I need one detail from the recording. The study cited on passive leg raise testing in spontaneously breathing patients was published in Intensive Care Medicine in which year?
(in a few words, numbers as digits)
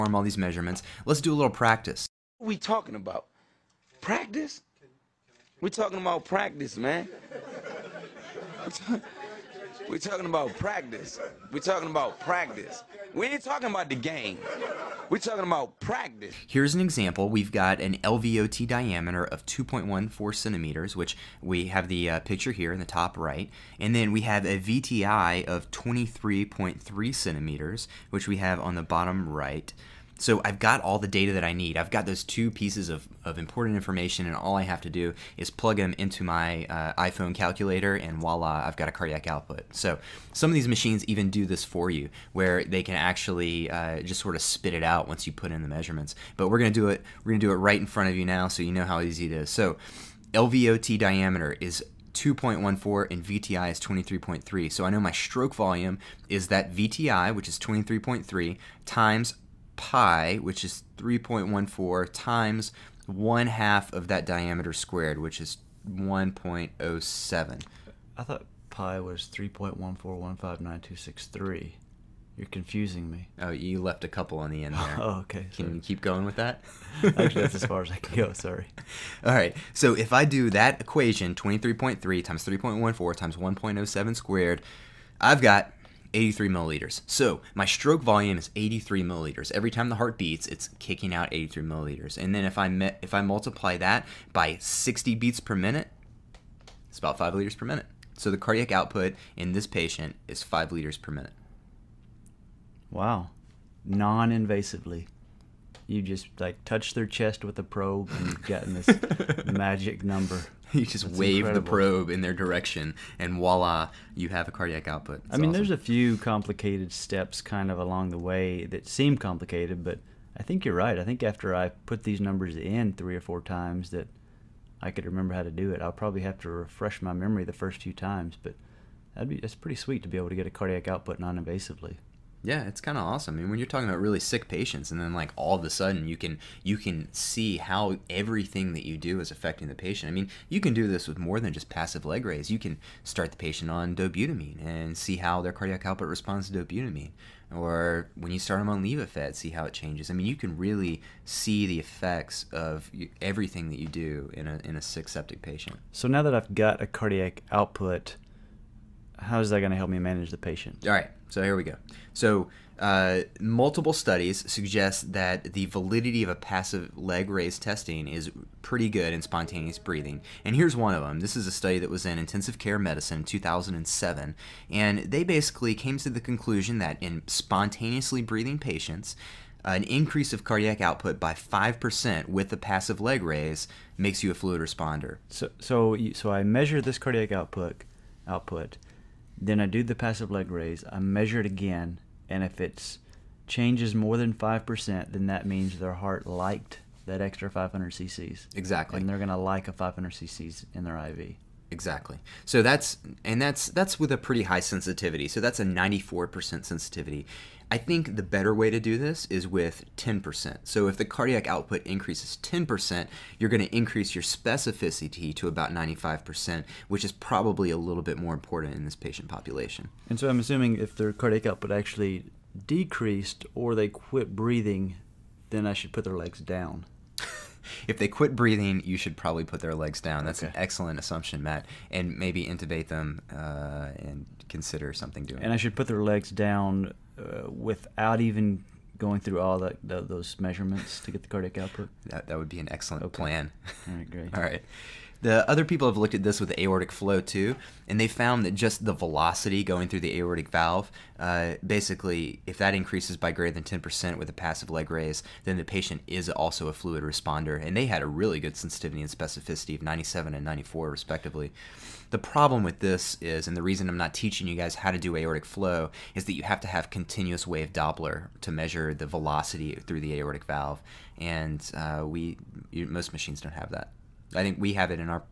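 2007.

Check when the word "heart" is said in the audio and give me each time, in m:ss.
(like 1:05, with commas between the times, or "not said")
1:29, 3:15.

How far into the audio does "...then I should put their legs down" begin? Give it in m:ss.
3:45.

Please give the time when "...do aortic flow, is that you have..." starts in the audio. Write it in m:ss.
4:24.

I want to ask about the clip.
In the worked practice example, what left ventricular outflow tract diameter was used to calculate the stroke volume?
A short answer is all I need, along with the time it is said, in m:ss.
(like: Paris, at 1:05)
2.14 cm, at 0:19.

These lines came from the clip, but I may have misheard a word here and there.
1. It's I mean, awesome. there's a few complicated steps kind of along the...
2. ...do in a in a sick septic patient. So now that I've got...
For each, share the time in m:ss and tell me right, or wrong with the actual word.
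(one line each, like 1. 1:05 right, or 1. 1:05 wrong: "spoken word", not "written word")
1. 1:55 right
2. 2:33 right.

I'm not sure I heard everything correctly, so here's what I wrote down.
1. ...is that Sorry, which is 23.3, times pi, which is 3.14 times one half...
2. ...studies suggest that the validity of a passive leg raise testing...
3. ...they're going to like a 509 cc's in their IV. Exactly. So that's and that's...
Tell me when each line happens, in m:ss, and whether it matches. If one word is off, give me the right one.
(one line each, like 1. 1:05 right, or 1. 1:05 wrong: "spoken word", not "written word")
1. 0:56 wrong: "VTI", not "Sorry"
2. 2:43 right
3. 3:19 wrong: "500", not "509".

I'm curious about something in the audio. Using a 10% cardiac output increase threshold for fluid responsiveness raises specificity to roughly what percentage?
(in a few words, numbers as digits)
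95%.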